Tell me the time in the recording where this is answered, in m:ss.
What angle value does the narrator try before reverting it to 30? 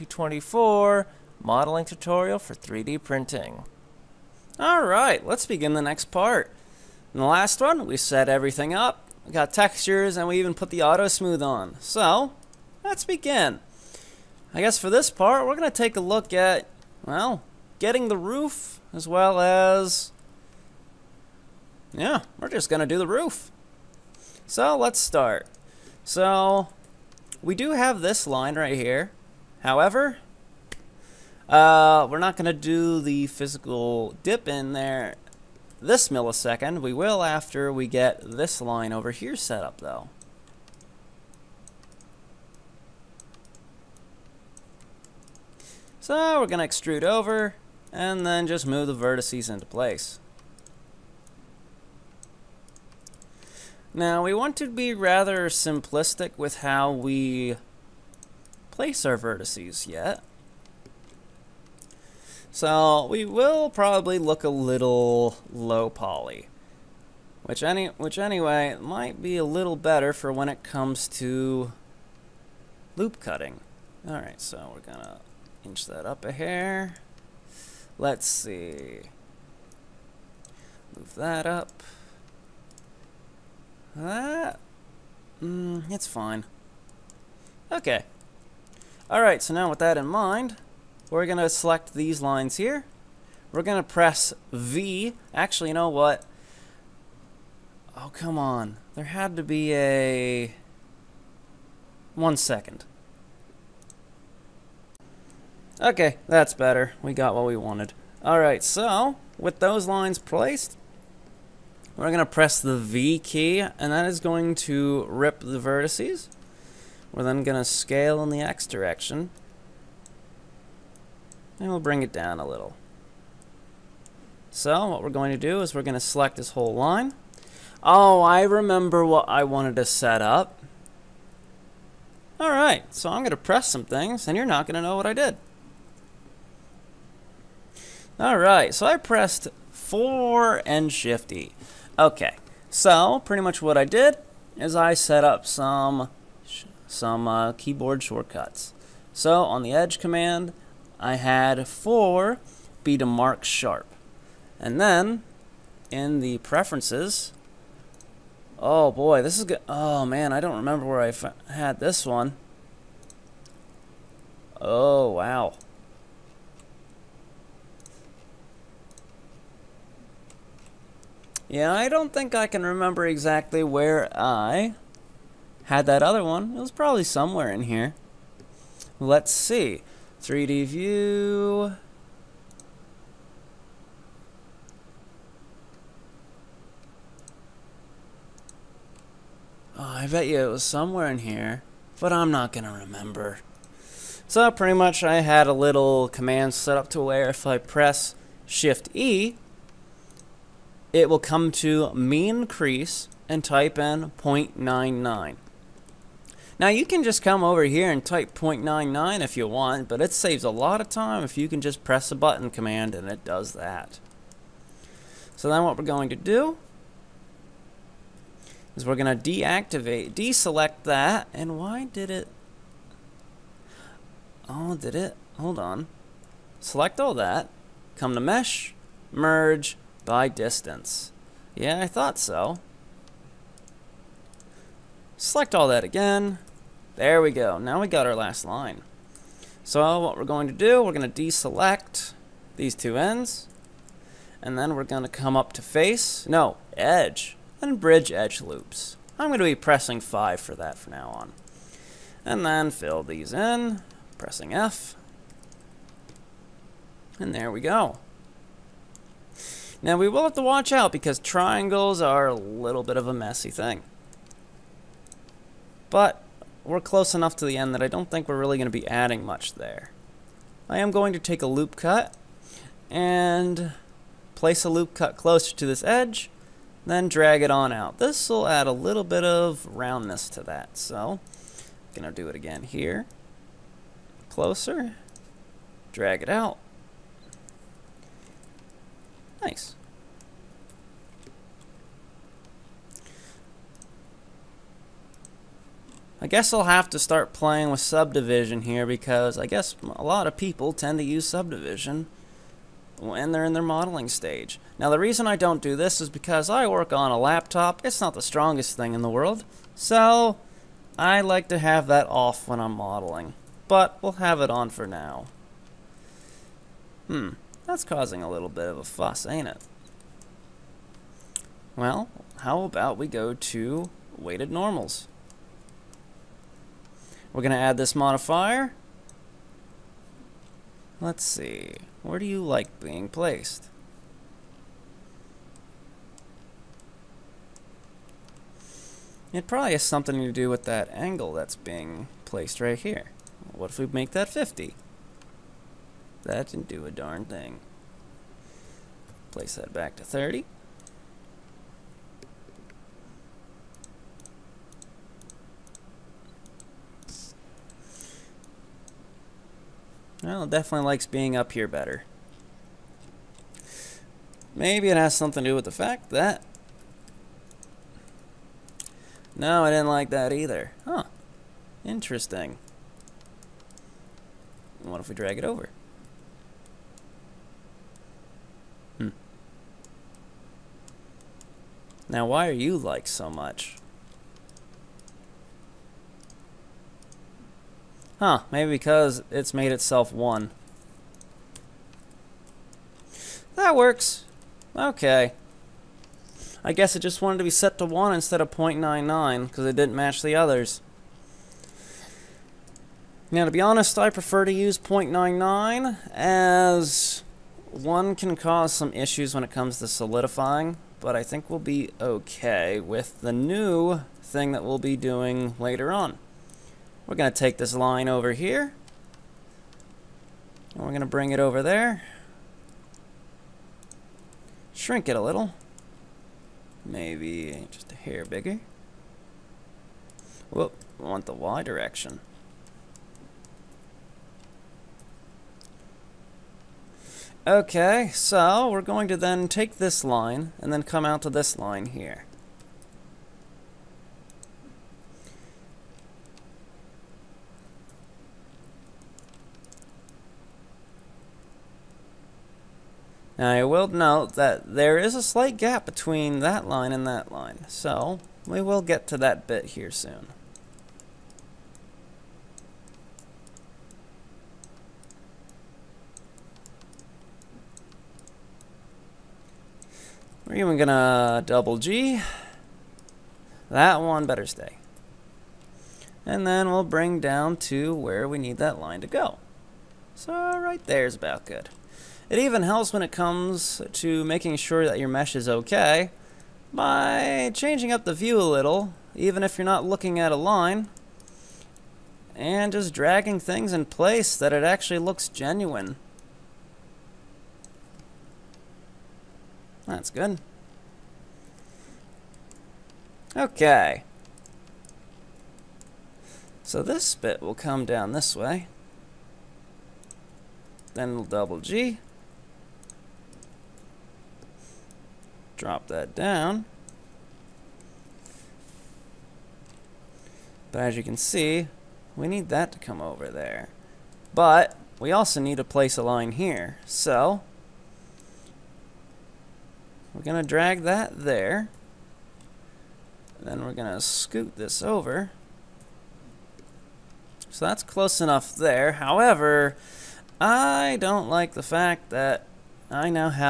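5:44.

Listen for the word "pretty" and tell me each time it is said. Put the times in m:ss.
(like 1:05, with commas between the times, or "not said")
2:23, 3:14.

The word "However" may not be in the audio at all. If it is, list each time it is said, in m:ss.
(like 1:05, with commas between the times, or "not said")
0:29, 8:58.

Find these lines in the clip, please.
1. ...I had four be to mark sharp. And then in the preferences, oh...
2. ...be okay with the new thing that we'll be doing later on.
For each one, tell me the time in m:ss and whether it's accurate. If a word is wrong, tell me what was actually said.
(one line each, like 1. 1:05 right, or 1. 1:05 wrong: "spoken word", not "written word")
1. 2:30 right
2. 6:51 right.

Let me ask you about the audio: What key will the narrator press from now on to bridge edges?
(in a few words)
5.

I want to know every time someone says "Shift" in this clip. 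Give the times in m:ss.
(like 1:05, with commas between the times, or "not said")
2:20, 3:18.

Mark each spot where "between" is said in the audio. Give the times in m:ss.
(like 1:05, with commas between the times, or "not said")
7:35.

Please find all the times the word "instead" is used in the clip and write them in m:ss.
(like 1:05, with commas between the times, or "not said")
6:38.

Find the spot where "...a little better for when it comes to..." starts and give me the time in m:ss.
1:09.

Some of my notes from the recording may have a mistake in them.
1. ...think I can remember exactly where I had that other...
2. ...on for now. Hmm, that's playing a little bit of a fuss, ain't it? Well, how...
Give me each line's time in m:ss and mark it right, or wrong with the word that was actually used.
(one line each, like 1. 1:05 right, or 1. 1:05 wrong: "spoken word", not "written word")
1. 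2:52 right
2. 5:14 wrong: "causing", not "playing".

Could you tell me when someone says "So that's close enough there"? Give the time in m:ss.
8:57.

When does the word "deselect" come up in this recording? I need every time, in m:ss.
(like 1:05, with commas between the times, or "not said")
3:40, 4:01.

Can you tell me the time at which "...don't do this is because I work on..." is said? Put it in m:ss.
5:05.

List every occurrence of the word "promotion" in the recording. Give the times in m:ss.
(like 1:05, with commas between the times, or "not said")
not said.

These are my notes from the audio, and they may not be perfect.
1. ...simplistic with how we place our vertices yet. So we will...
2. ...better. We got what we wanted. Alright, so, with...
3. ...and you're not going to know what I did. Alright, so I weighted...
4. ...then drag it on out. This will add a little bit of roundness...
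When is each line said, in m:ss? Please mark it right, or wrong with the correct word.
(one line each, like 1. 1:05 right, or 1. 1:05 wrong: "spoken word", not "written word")
1. 0:55 right
2. 1:46 right
3. 2:14 wrong: "pressed", not "weighted"
4. 4:36 right.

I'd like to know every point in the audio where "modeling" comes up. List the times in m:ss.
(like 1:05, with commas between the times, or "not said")
0:01, 5:03, 5:12.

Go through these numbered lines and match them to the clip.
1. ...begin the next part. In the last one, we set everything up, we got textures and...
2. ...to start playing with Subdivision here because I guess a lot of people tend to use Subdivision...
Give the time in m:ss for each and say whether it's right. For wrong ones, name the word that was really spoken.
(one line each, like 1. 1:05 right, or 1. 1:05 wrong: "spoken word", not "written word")
1. 0:05 right
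2. 4:56 right.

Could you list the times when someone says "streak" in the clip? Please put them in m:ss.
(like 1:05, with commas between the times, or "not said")
not said.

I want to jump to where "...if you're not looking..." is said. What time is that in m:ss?
8:09.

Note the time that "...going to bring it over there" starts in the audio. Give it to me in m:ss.
7:00.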